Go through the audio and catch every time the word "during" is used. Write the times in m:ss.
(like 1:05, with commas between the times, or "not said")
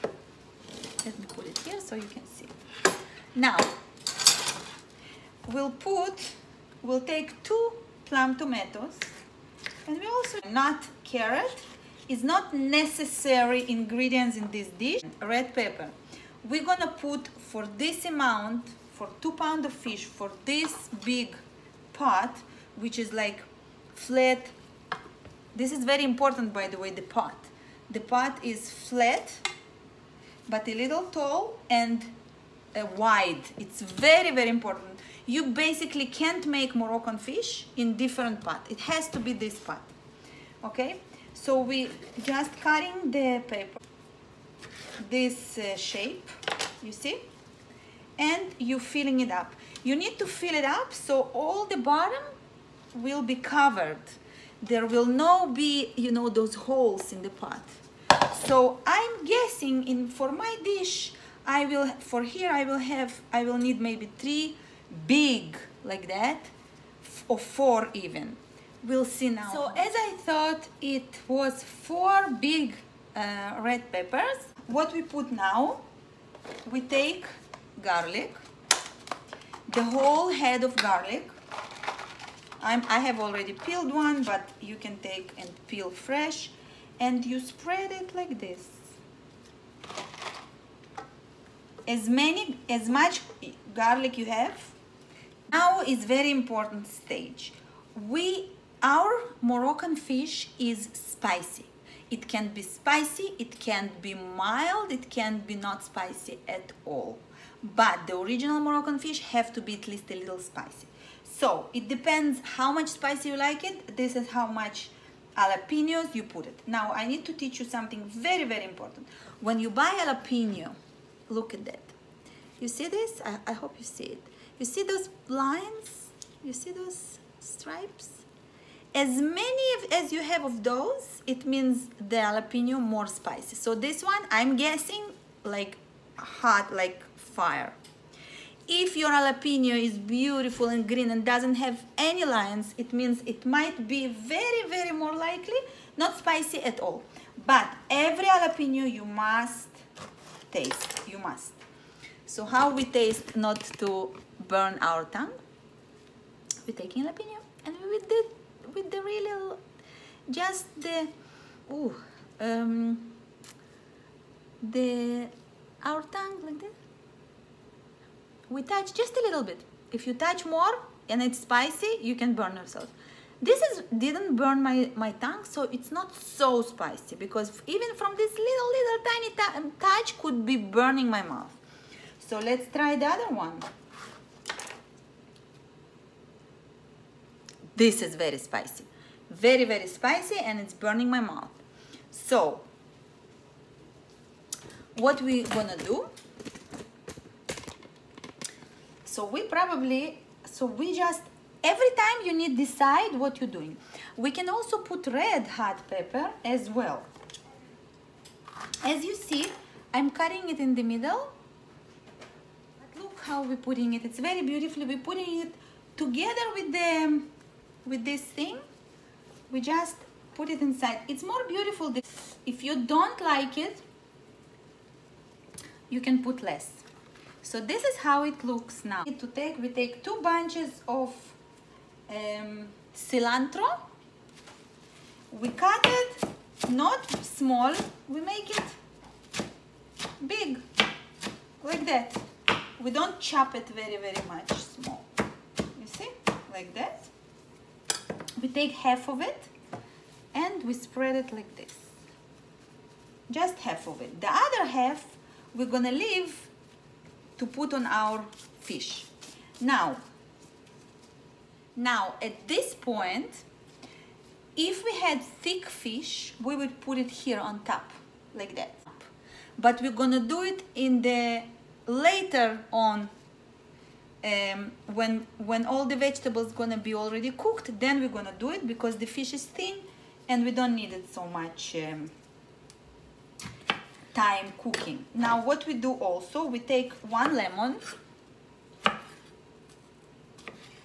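not said.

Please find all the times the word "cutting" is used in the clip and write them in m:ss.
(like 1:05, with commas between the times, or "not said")
0:42, 3:30.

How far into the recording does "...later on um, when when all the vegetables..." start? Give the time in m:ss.
4:31.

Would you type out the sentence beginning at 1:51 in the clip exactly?
So it depends how much spicy you like it.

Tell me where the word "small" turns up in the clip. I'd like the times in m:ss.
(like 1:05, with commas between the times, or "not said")
3:57, 4:04.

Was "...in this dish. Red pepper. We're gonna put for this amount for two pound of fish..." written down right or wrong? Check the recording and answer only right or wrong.
right.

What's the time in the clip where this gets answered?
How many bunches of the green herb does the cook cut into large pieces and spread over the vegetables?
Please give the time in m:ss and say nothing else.
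3:50.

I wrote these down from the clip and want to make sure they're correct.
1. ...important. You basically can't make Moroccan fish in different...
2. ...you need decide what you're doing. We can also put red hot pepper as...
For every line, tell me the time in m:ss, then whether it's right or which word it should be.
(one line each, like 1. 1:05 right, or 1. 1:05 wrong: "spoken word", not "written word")
1. 0:34 right
2. 3:22 right.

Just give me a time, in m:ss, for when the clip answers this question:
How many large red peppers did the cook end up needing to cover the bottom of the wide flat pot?
1:11.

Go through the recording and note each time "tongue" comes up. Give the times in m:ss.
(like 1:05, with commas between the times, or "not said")
2:35, 2:46, 2:55.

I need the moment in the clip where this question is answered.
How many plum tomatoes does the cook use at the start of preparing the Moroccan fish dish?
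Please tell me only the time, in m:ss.
0:07.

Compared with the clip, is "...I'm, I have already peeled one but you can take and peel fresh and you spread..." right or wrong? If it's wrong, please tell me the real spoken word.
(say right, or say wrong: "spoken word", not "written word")
right.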